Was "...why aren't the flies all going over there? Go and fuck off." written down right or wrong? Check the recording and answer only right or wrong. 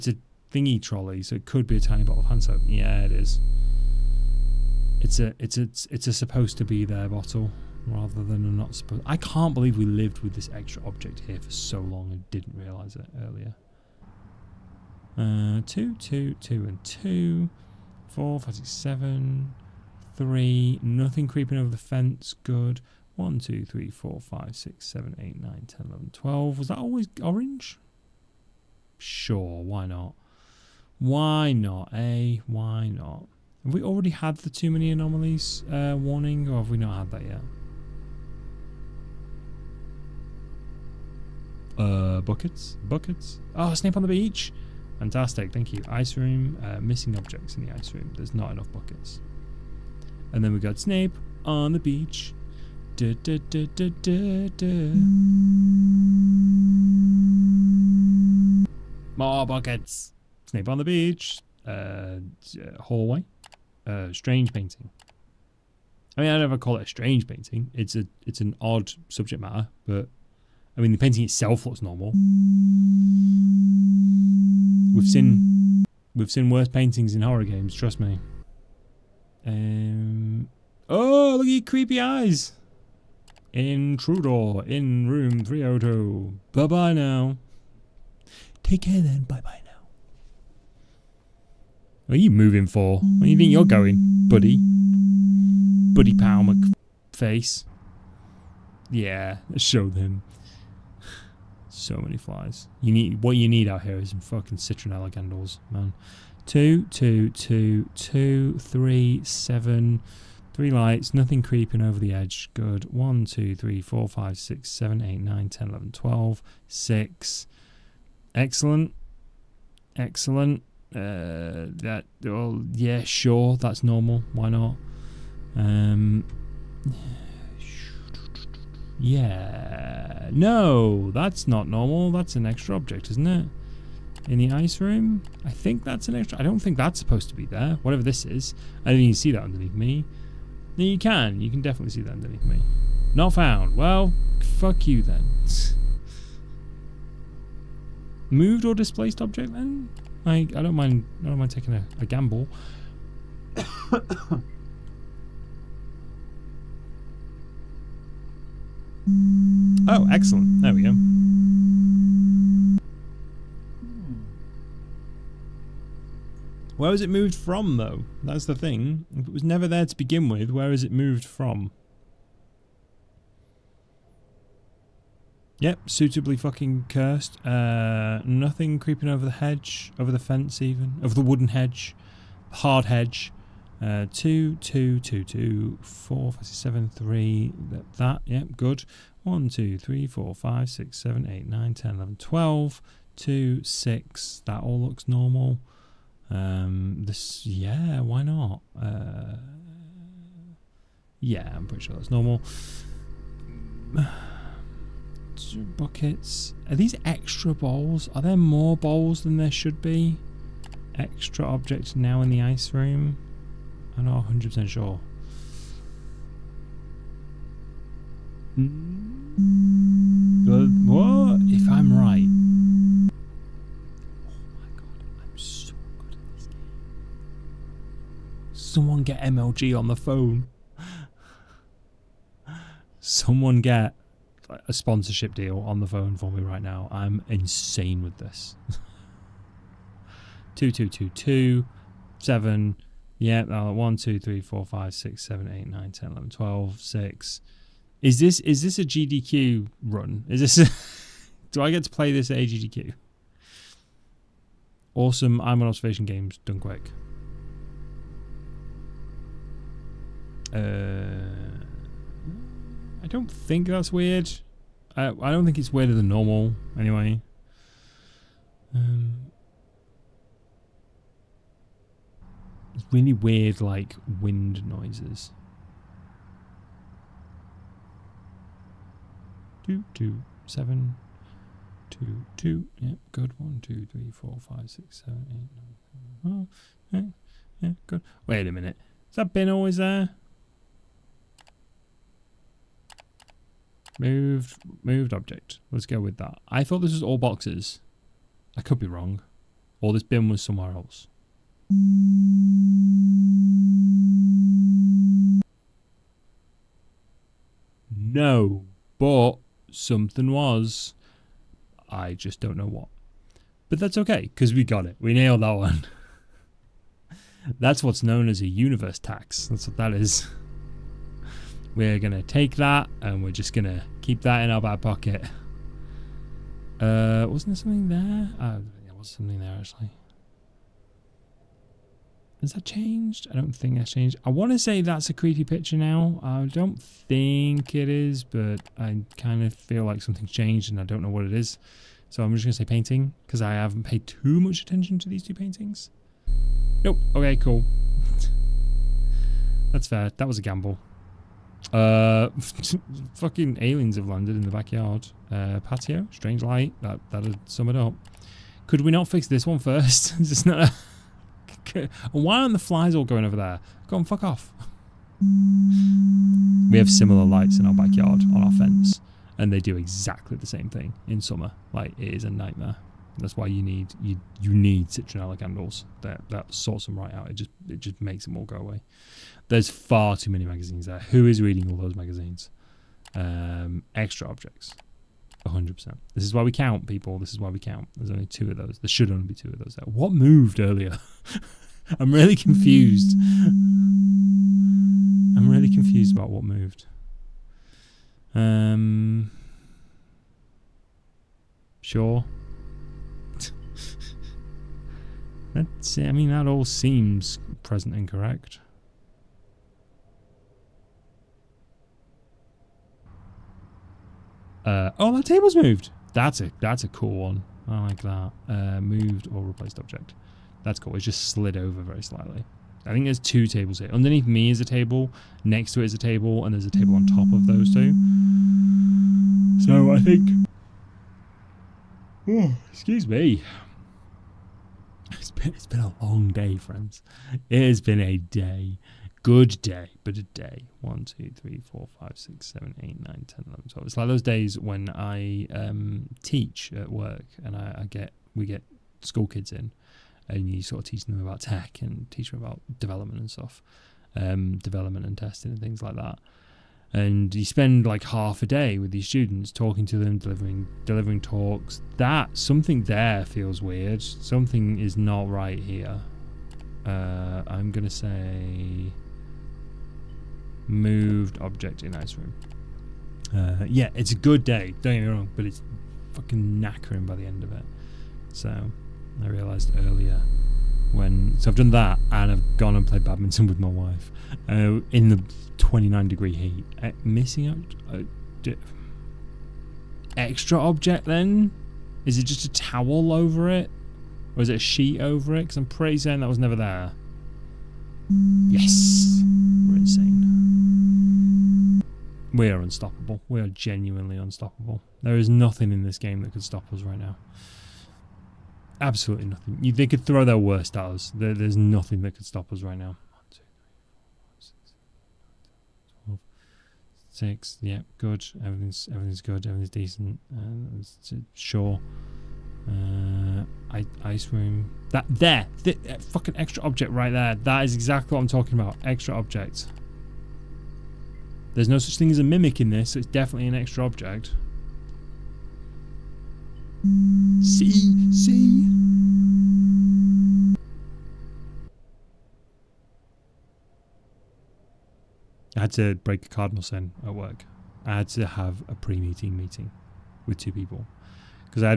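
right.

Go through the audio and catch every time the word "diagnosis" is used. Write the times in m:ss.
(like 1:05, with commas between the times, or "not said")
not said.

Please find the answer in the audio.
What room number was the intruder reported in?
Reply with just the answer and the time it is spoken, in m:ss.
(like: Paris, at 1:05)
302, at 1:25.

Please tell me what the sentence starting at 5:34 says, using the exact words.
I want to say that's a creepy picture now.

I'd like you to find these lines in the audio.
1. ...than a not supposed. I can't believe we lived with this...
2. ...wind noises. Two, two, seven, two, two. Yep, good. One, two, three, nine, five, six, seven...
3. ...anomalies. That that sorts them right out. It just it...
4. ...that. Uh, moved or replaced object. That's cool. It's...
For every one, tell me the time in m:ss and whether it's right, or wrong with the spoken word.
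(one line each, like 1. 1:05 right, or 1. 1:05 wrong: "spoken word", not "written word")
1. 0:08 right
2. 4:34 wrong: "four", not "nine"
3. 6:15 wrong: "candles", not "anomalies"
4. 6:58 right.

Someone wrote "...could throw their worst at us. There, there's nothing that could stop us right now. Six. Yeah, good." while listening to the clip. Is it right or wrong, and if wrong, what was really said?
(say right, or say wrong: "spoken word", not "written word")
right.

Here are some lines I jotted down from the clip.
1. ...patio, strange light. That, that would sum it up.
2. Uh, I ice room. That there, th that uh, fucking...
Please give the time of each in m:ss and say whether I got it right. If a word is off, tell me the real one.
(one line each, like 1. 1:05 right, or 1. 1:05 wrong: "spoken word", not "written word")
1. 5:55 right
2. 8:42 right.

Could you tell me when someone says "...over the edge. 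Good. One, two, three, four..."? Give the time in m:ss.
1:51.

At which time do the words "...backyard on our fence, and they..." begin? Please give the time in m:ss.
6:07.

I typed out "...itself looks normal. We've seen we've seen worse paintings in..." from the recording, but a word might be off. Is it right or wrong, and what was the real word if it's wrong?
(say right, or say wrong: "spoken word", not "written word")
right.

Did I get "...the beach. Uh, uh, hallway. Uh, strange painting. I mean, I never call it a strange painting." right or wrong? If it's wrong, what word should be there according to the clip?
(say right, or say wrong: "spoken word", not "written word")
right.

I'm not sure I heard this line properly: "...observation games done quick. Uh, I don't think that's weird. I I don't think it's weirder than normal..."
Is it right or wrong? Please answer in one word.
right.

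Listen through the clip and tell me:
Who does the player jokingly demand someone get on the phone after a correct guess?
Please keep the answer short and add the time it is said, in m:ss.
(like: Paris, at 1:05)
MLG, at 3:49.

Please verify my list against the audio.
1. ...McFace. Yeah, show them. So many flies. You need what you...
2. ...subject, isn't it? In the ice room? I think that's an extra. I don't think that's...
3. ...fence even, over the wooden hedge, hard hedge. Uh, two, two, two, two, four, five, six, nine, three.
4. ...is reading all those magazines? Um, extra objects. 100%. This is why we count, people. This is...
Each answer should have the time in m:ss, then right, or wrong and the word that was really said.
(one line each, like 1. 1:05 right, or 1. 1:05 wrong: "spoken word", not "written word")
1. 1:37 right
2. 2:12 wrong: "object", not "subject"
3. 3:00 wrong: "seven", not "nine"
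4. 6:21 right.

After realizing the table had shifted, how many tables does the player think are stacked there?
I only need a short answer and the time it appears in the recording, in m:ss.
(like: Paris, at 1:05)
3, at 7:06.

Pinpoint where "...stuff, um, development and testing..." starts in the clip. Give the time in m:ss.
7:33.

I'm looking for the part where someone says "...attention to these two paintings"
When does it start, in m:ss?
5:44.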